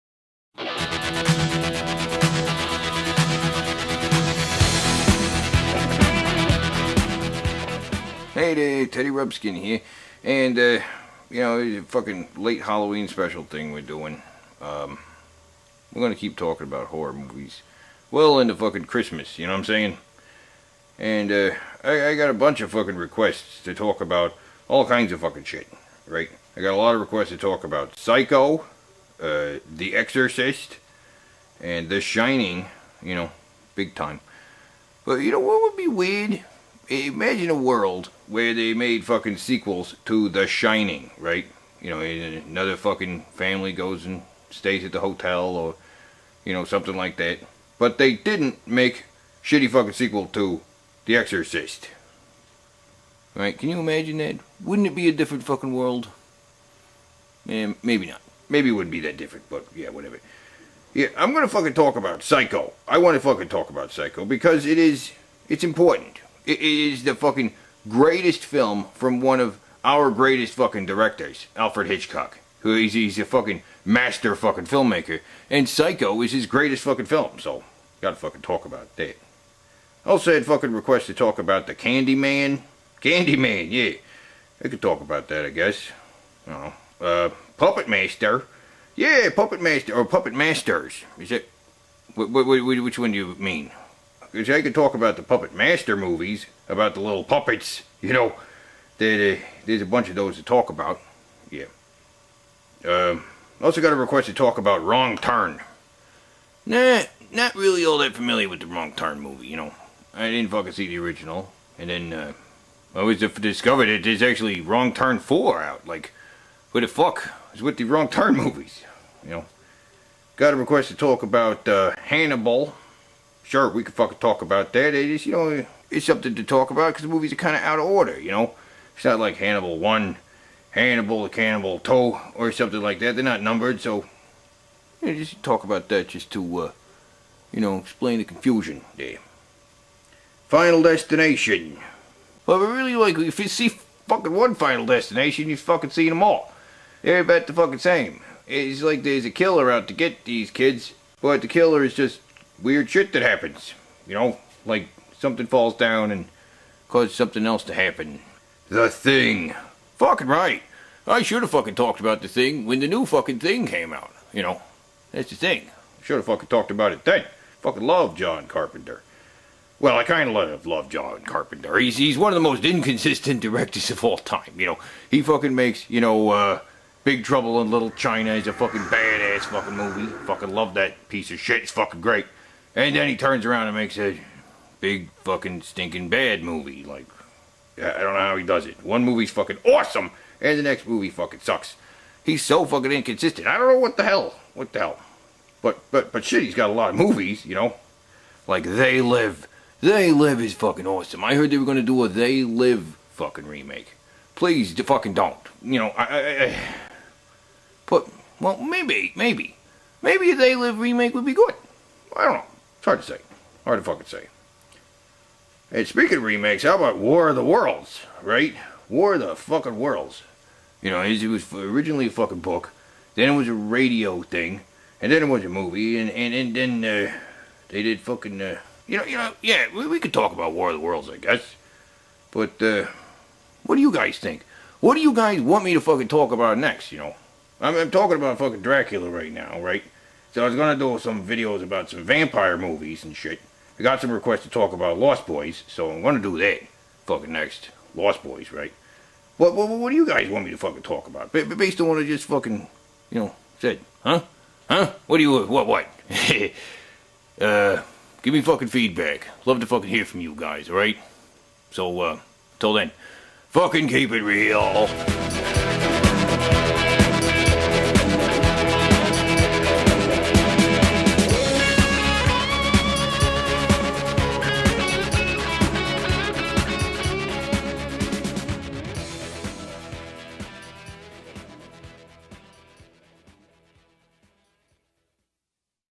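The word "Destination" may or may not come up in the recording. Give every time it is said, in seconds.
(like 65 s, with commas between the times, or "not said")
140 s, 144 s.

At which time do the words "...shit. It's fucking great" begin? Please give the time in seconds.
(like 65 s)
181 s.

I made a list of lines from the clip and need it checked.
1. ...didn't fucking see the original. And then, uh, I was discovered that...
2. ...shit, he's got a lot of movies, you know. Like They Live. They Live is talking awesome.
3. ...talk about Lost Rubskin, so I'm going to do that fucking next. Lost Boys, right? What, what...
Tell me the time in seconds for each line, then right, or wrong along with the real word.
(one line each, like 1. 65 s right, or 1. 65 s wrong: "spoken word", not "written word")
1. 110 s right
2. 196 s wrong: "fucking", not "talking"
3. 244 s wrong: "Boys", not "Rubskin".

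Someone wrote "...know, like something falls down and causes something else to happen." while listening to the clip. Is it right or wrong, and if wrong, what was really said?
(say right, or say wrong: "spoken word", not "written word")
right.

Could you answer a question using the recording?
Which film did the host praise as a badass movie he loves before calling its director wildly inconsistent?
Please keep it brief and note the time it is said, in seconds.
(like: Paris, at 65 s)
Big Trouble in Little China, at 177 s.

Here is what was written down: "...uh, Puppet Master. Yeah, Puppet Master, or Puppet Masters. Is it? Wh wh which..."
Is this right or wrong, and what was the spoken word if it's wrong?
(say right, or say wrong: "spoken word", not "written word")
right.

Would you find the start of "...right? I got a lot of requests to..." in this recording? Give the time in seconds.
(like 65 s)
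26 s.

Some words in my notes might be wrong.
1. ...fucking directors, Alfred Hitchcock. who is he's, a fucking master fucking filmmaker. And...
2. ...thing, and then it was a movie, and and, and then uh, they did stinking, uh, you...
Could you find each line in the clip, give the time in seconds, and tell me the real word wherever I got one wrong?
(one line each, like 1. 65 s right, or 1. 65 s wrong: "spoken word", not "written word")
1. 70 s right
2. 224 s wrong: "fucking", not "stinking".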